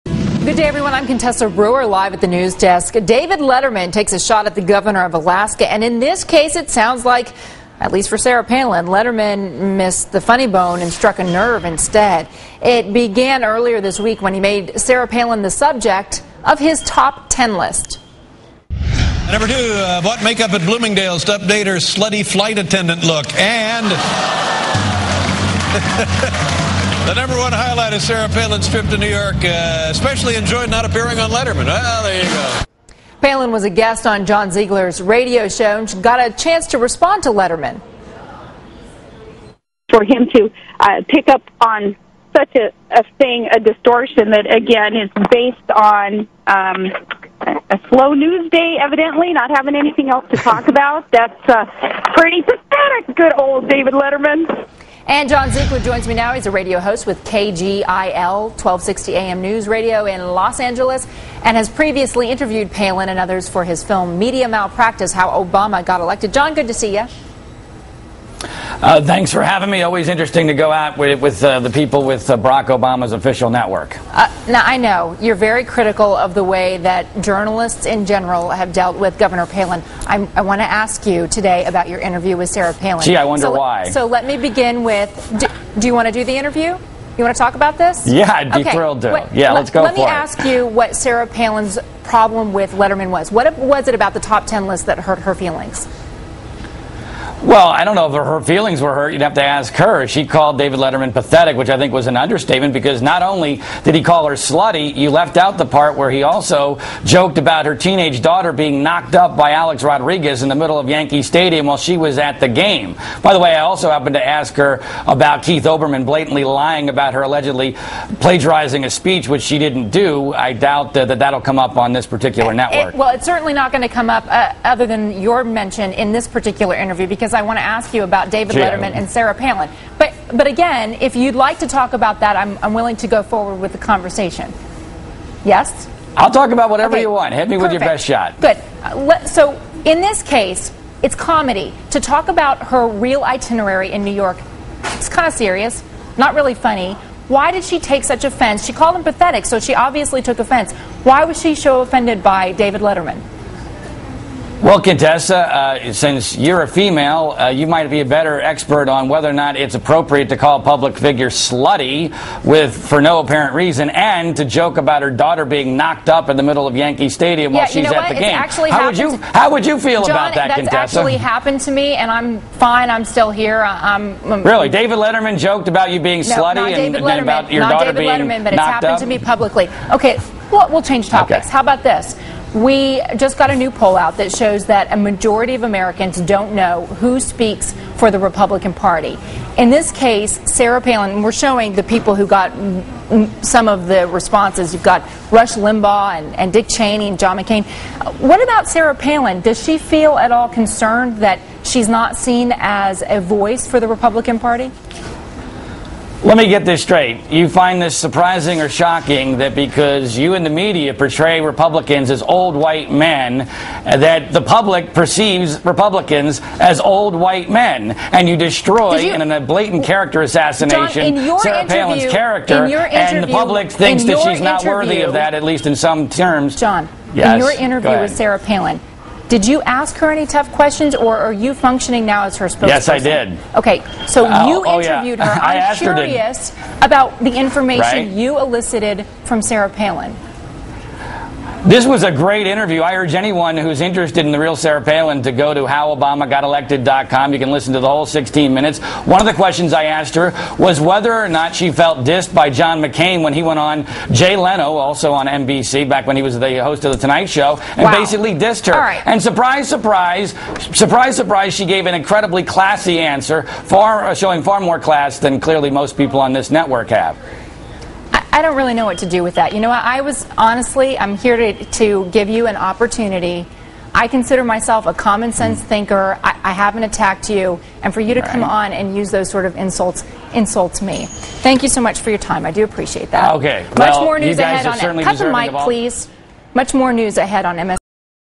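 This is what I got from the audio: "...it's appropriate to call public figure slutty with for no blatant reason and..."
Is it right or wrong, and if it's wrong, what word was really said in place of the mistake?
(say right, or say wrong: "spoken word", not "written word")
wrong: "apparent", not "blatant".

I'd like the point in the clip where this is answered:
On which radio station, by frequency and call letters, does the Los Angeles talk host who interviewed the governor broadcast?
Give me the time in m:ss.
0:57.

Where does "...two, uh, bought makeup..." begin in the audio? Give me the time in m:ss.
0:19.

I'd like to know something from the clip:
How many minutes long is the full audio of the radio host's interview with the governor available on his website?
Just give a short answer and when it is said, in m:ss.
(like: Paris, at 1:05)
16, at 4:08.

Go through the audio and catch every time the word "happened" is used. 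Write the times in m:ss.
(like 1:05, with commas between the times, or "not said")
1:53, 2:51, 2:58.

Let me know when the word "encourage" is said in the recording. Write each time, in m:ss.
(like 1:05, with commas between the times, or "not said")
not said.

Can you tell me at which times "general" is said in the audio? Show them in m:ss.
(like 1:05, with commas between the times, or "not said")
1:18.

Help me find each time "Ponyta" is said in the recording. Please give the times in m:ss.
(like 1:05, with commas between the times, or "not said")
not said.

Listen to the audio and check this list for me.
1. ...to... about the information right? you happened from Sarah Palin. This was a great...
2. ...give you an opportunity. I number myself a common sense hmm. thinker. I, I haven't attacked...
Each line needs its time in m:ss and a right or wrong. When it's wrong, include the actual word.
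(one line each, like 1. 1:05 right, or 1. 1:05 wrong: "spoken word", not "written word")
1. 3:56 wrong: "elicited", not "happened"
2. 4:32 wrong: "consider", not "number".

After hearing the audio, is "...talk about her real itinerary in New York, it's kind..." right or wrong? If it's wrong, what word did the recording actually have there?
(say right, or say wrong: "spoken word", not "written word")
right.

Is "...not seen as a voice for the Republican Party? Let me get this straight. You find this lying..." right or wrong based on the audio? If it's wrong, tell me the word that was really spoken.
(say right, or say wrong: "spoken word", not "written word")
wrong: "surprising", not "lying".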